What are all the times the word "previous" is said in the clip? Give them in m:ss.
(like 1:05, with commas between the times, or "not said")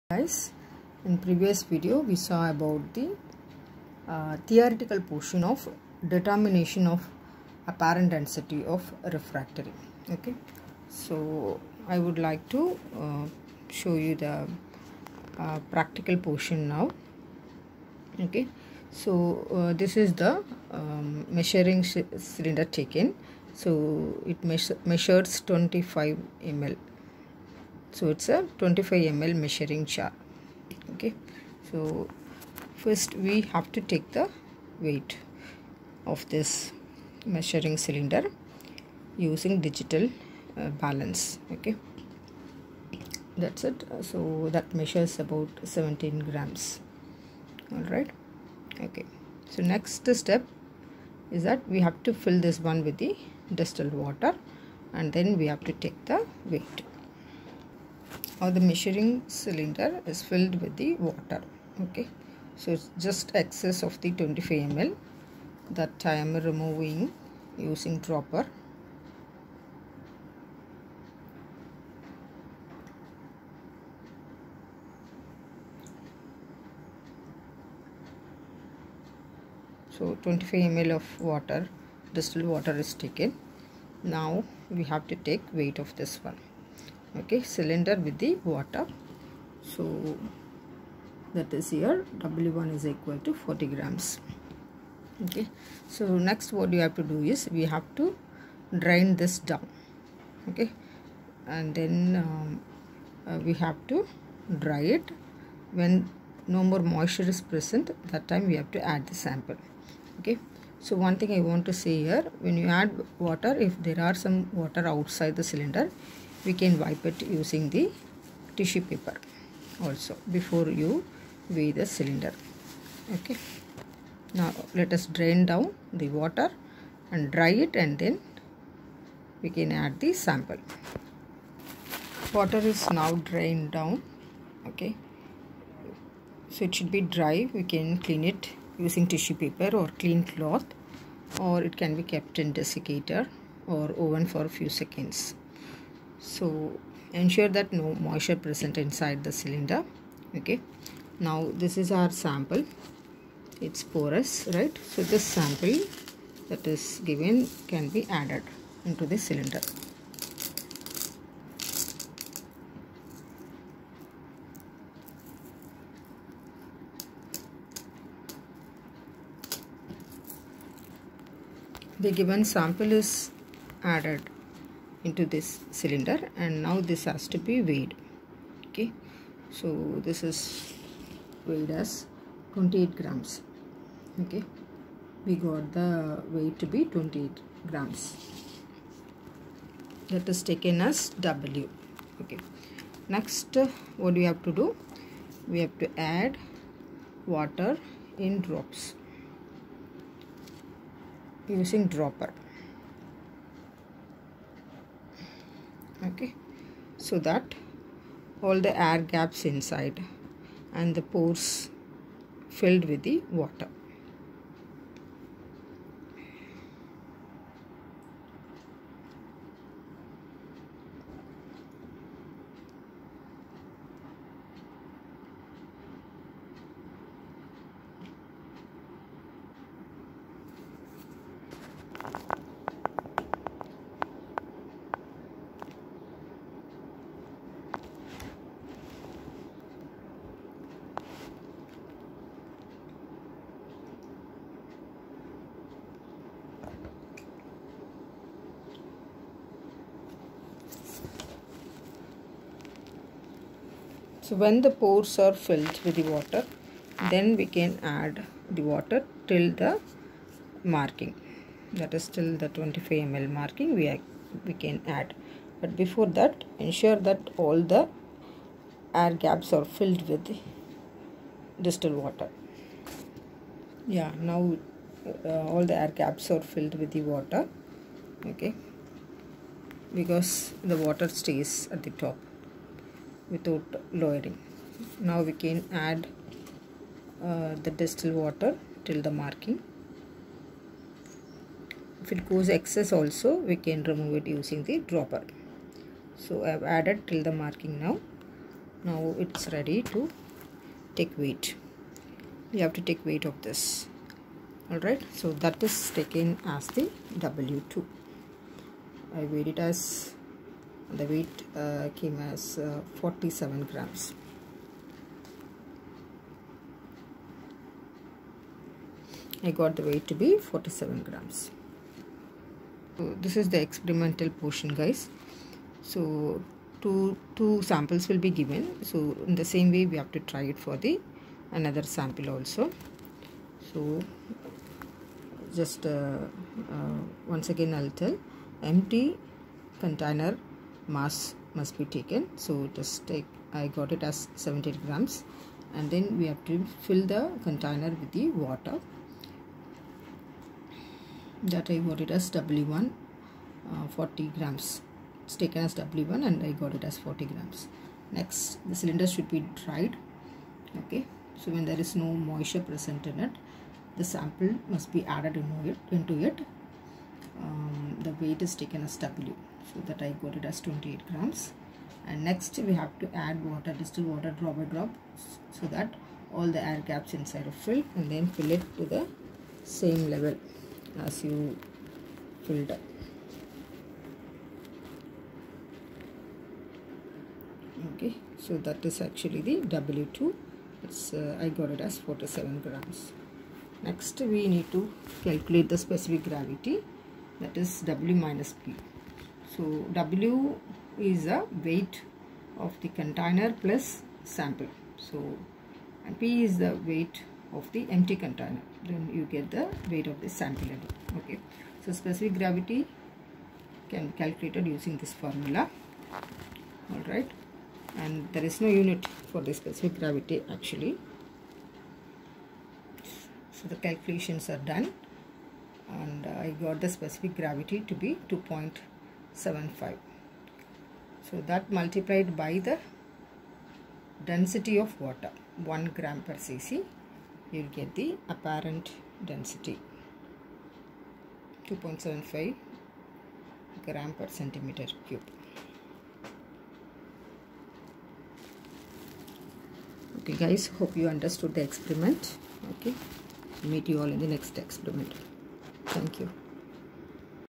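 0:01.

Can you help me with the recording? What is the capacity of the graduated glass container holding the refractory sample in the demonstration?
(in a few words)
25 ml.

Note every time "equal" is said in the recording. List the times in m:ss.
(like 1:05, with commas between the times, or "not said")
1:32.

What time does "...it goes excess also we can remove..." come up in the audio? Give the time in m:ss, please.
4:52.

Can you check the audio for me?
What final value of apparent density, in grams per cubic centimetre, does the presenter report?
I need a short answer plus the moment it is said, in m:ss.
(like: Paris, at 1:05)
2.75, at 7:21.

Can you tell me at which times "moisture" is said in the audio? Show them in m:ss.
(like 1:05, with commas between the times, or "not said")
1:46, 2:27, 6:02.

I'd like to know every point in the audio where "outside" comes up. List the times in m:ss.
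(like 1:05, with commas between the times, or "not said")
1:54.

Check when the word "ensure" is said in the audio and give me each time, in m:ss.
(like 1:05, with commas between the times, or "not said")
2:27, 4:26.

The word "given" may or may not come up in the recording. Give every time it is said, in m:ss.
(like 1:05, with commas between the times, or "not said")
2:37, 2:52, 5:28.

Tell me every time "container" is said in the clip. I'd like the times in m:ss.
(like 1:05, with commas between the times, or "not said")
5:39, 5:47, 6:42, 6:48.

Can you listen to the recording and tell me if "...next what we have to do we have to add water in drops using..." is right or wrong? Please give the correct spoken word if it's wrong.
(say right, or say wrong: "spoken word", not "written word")
right.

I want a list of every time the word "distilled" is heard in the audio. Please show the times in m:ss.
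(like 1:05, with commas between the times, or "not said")
0:53, 1:22, 4:31, 4:47, 6:13.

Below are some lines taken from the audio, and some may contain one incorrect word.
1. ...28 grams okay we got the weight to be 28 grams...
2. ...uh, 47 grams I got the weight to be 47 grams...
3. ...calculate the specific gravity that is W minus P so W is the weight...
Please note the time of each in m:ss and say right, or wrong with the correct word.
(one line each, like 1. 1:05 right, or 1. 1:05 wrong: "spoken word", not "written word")
1. 3:02 right
2. 5:12 right
3. 6:35 right.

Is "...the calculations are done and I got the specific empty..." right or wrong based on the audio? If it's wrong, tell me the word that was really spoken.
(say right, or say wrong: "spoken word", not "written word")
wrong: "gravity", not "empty".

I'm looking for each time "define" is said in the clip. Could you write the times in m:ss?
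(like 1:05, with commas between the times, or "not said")
not said.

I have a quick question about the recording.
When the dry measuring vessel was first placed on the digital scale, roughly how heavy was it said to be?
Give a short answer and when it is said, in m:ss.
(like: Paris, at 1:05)
17 grams, at 0:45.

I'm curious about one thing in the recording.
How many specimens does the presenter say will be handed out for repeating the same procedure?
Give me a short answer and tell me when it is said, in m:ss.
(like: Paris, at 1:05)
Two, at 5:26.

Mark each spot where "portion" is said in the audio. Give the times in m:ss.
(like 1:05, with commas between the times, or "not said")
0:05, 0:16, 5:24.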